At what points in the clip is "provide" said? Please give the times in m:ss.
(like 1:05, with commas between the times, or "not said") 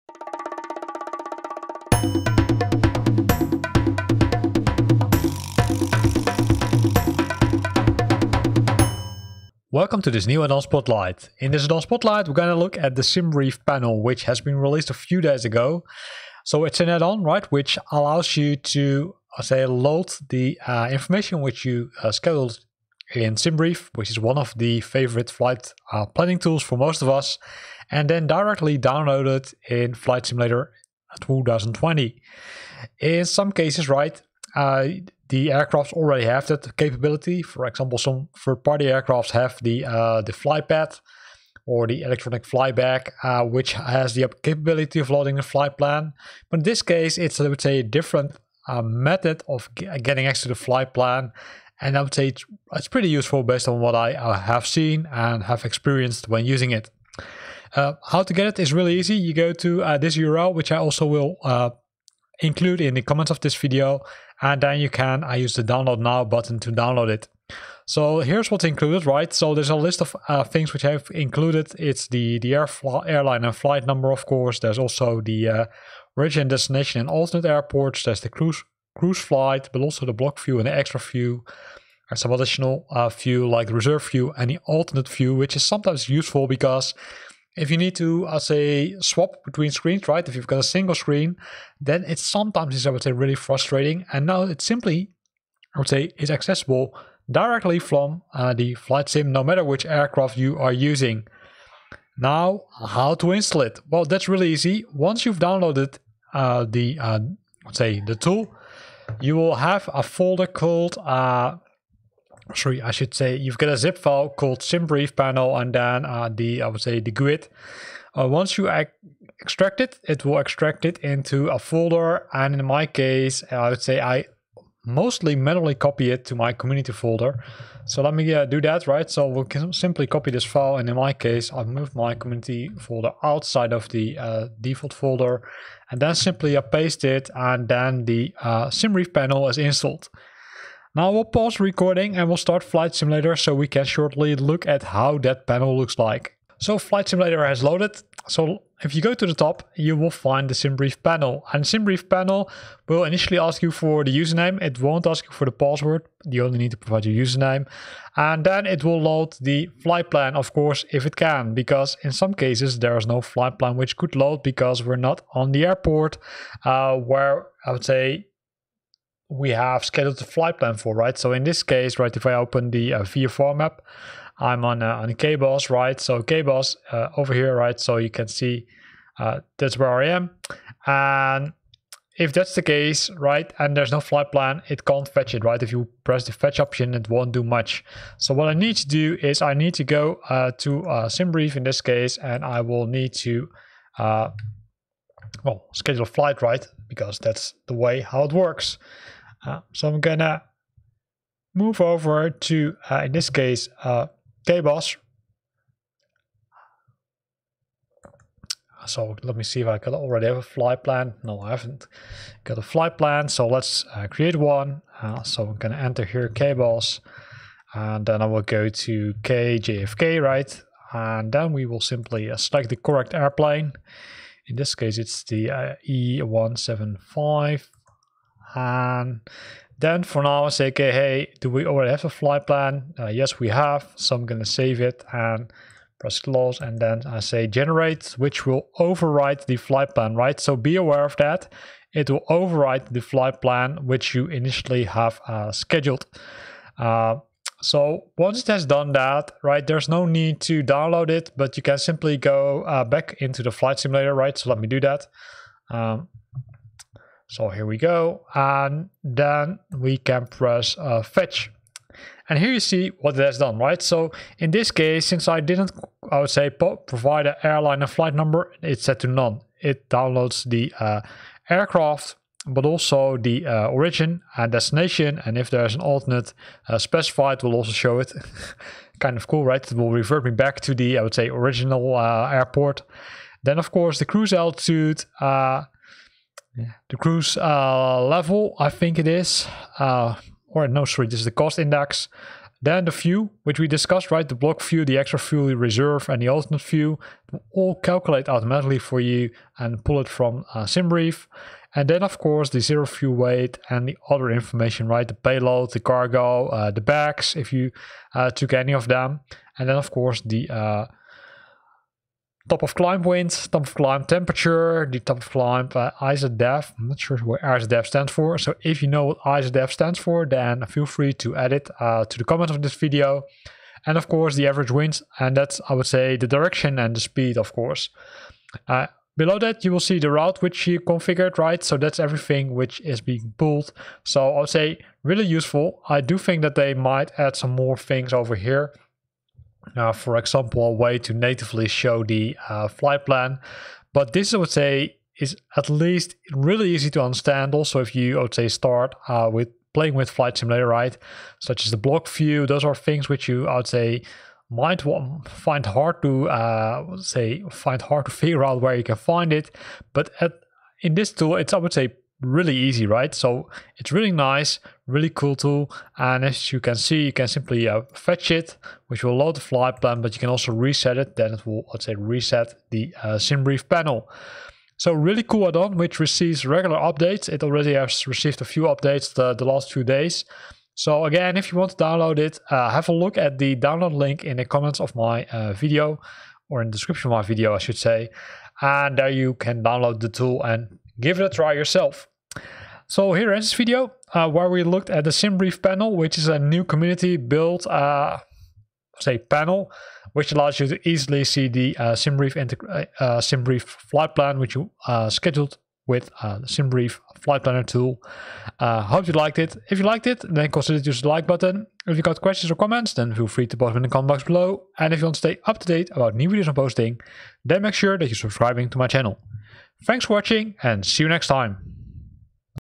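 2:36, 4:26.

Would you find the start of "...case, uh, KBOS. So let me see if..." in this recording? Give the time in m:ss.
3:23.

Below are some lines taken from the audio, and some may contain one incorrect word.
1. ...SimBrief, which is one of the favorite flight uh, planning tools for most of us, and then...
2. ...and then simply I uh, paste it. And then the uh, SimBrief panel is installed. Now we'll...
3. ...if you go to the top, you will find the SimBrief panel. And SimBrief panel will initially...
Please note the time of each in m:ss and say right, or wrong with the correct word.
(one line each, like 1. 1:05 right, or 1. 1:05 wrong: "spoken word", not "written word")
1. 0:23 right
2. 2:15 right
3. 2:28 right.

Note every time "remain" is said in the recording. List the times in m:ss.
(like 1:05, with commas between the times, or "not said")
not said.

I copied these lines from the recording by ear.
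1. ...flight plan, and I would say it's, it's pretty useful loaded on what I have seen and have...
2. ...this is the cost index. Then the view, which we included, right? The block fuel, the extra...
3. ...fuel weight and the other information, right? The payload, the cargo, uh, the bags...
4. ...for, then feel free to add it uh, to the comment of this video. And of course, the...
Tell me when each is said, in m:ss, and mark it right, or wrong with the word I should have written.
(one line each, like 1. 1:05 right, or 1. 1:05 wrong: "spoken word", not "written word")
1. 0:50 wrong: "based", not "loaded"
2. 4:51 wrong: "discussed", not "included"
3. 5:02 right
4. 5:19 right.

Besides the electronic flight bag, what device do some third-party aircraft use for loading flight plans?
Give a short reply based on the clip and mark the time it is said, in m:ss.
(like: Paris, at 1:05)
flypad, at 0:40.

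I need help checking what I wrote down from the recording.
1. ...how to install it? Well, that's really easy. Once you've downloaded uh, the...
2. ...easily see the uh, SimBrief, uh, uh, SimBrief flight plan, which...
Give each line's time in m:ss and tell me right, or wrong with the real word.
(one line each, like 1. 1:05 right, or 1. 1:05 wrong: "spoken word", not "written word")
1. 1:42 right
2. 6:40 right.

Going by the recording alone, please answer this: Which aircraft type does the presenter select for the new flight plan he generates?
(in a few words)
E175.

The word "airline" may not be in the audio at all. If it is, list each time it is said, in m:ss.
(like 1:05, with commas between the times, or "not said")
1:13, 4:27.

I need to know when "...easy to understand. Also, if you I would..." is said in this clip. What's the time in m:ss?
5:46.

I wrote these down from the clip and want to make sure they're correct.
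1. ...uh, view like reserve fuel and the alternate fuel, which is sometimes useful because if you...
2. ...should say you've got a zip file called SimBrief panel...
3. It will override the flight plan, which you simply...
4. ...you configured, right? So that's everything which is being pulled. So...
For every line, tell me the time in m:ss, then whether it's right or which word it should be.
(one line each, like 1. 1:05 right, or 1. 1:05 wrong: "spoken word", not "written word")
1. 1:22 right
2. 1:52 right
3. 4:01 wrong: "initially", not "simply"
4. 5:30 right.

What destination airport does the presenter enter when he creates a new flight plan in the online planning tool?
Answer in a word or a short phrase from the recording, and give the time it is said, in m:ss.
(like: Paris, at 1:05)
KJFK, at 3:39.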